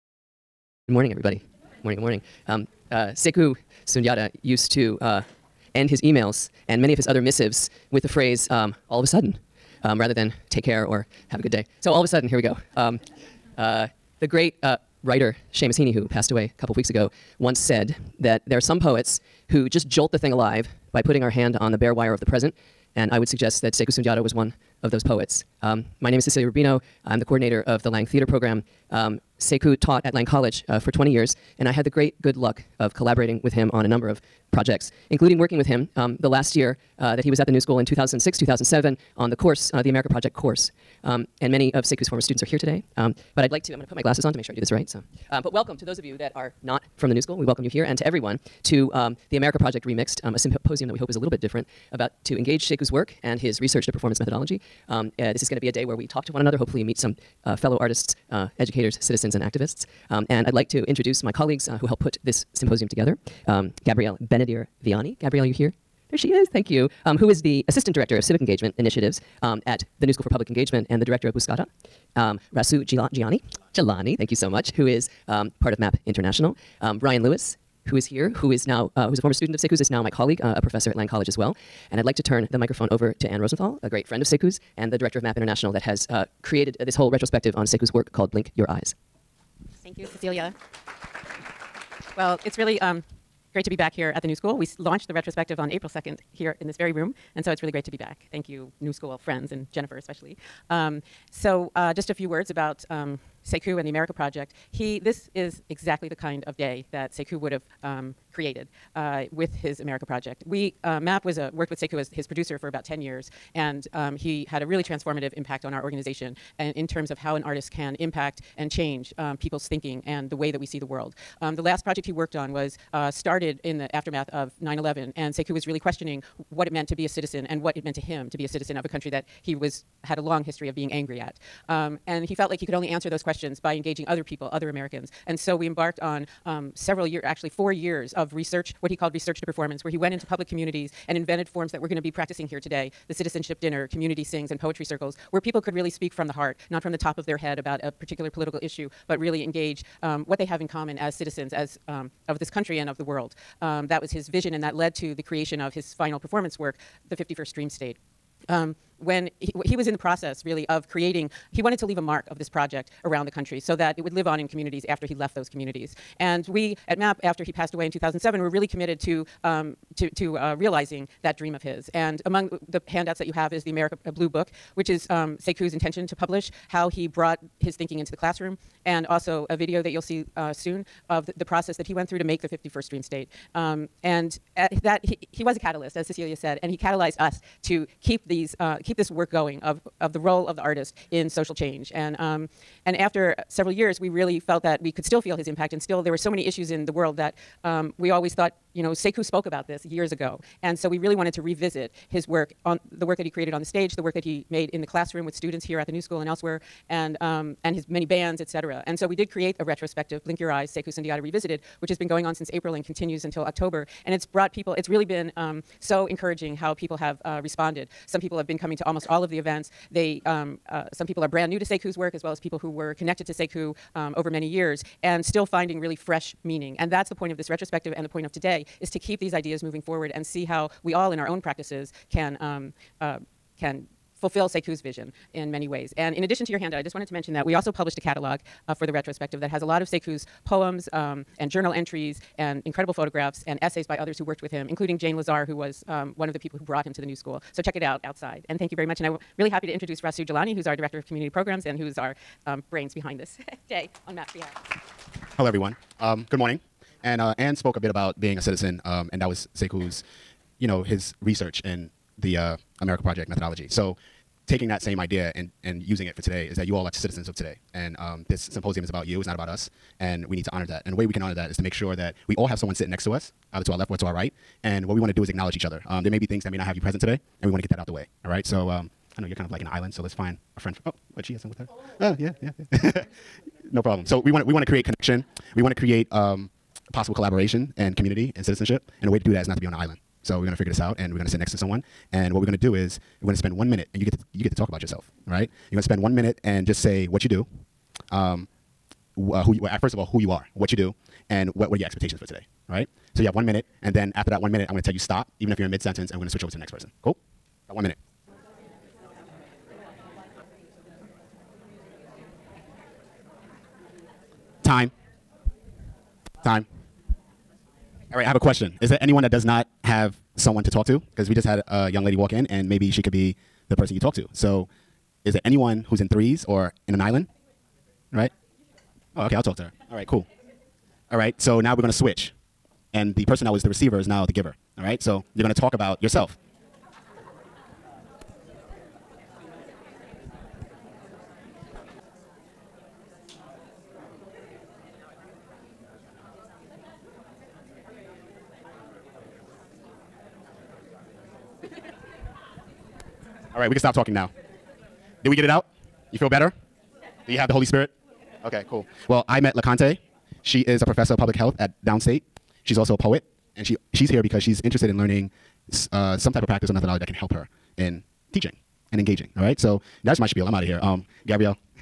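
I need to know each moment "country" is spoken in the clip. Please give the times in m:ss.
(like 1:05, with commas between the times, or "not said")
2:08, 2:32, 2:43.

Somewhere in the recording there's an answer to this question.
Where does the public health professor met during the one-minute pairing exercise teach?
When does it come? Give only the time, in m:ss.
6:01.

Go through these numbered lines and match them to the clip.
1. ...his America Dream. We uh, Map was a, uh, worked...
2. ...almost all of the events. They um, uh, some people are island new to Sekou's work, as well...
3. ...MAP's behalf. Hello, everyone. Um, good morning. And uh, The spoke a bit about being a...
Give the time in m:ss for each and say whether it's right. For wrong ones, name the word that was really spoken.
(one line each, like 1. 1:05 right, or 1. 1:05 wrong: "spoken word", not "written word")
1. 1:49 wrong: "Project", not "Dream"
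2. 3:38 wrong: "brand", not "island"
3. 4:14 wrong: "Ann", not "The".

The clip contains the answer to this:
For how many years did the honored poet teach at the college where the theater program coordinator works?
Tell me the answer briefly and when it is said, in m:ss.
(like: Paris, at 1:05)
20, at 0:30.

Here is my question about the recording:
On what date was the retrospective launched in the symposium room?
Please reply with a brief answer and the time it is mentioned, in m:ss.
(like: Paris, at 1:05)
April 2nd, at 1:35.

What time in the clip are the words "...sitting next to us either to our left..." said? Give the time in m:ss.
4:32.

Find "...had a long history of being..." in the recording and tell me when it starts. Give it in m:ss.
2:10.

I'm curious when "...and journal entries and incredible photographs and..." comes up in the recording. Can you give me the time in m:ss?
4:01.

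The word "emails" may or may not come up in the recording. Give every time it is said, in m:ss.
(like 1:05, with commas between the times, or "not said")
0:06.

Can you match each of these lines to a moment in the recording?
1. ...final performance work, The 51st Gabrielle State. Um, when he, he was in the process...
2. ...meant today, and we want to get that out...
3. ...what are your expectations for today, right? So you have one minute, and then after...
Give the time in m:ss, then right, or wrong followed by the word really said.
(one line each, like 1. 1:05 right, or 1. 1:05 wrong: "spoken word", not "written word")
1. 2:35 wrong: "Dream", not "Gabrielle"
2. 4:36 wrong: "present", not "meant"
3. 5:01 right.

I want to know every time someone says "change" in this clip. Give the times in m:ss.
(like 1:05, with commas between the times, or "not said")
1:58, 3:11.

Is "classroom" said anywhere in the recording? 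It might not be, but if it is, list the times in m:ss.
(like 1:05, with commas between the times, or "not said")
2:58, 3:24.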